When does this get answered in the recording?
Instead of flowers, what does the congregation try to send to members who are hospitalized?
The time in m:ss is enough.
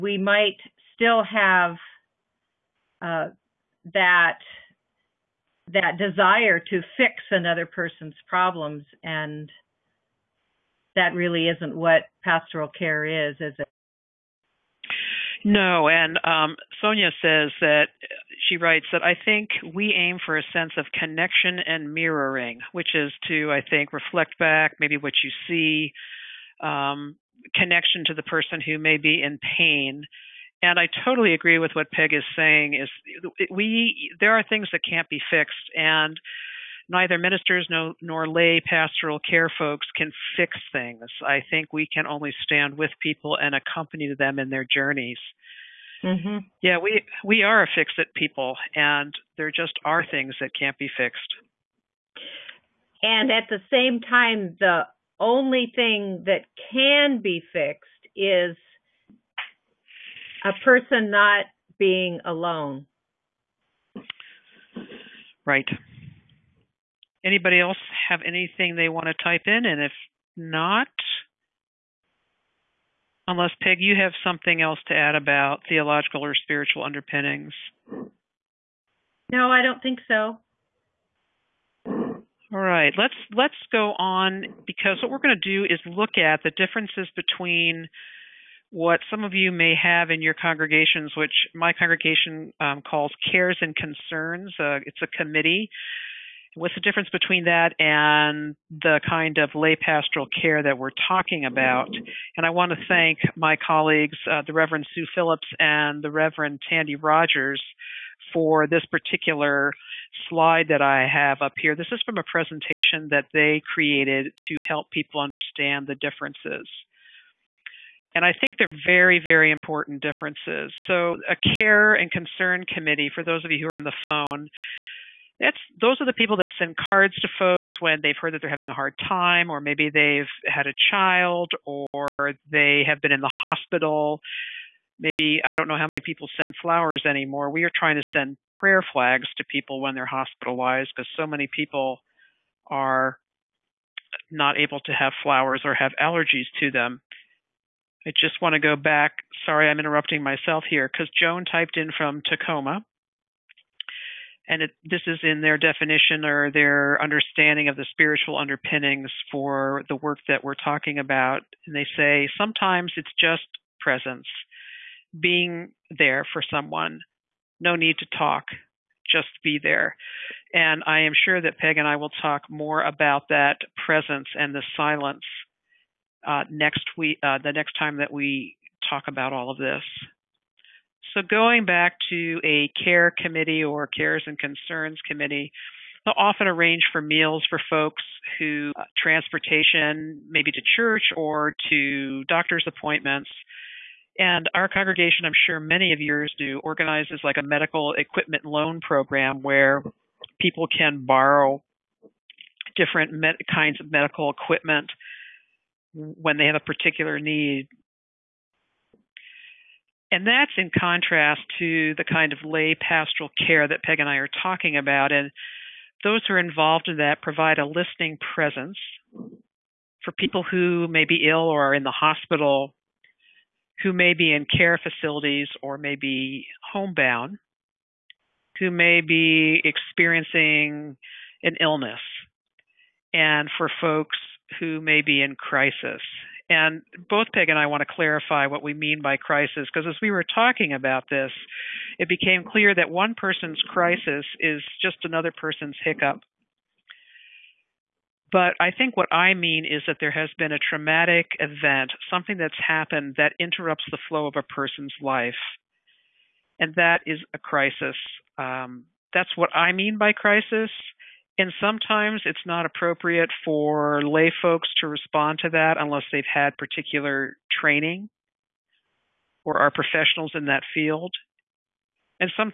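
2:18.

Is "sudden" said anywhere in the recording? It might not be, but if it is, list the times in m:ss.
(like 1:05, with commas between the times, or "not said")
not said.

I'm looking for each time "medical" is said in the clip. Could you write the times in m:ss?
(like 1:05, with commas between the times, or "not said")
3:17, 3:23.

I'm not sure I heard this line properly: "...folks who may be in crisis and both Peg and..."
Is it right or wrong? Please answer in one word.
right.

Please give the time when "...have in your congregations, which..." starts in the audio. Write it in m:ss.
1:29.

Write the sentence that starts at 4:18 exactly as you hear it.
Um, that's what I mean by crisis.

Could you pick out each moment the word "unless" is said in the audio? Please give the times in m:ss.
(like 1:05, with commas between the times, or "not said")
1:13, 4:25.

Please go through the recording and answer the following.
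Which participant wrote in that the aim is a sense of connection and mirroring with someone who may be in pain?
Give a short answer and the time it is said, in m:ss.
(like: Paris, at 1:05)
Sonia, at 0:16.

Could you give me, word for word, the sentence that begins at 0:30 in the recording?
And I totally agree with what Peg is saying.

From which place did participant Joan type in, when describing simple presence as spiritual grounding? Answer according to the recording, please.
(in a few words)
Tacoma.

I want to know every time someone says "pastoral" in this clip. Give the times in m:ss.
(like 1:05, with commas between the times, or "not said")
0:12, 0:38, 1:39, 3:32.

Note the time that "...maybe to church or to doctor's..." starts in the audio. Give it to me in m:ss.
3:10.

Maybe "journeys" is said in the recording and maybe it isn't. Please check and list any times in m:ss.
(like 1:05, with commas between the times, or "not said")
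0:44.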